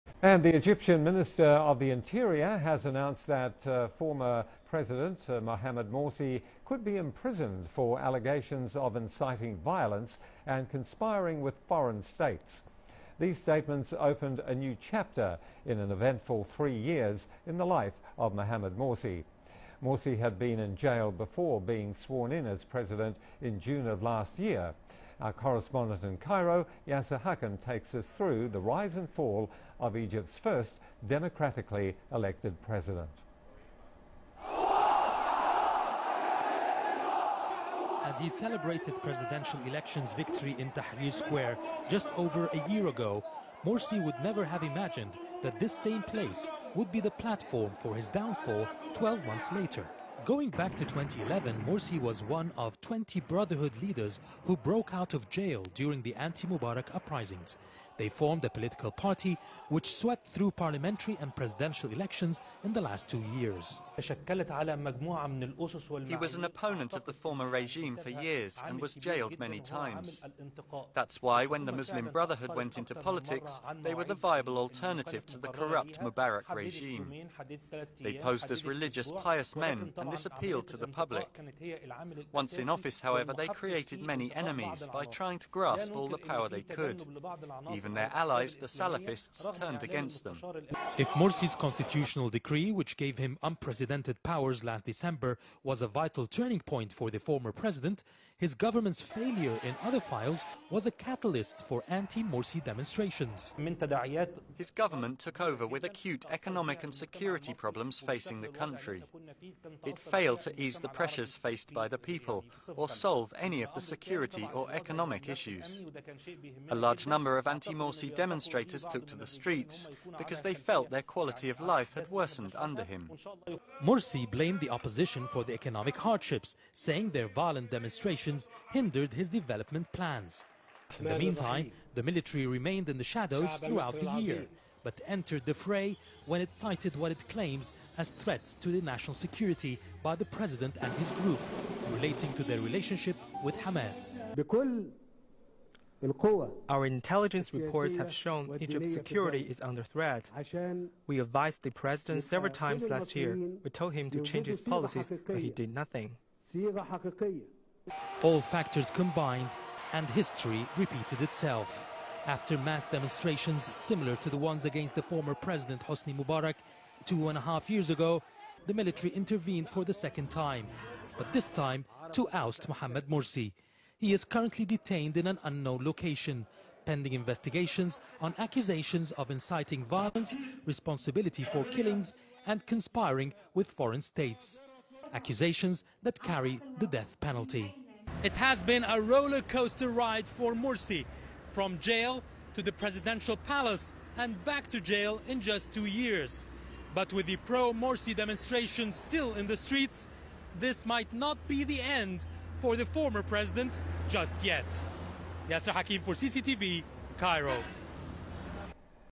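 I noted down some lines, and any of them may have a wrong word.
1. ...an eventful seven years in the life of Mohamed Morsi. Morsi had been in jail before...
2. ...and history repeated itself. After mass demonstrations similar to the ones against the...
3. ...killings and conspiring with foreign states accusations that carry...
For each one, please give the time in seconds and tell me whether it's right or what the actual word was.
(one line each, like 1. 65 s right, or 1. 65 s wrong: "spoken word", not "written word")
1. 15 s wrong: "three", not "seven"
2. 159 s right
3. 181 s right.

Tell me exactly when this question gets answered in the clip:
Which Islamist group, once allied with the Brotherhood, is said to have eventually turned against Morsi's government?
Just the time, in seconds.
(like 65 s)
88 s.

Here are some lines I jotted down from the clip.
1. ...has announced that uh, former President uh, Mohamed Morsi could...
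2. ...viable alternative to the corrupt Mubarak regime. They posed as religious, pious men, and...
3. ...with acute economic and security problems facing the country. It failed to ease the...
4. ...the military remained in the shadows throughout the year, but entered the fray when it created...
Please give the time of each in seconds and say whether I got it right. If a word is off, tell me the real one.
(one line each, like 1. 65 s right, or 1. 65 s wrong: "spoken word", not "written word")
1. 2 s right
2. 74 s right
3. 105 s right
4. 131 s wrong: "cited", not "created".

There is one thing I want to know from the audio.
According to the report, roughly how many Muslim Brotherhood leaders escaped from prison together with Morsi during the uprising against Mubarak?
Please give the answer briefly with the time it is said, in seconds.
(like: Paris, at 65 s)
20, at 52 s.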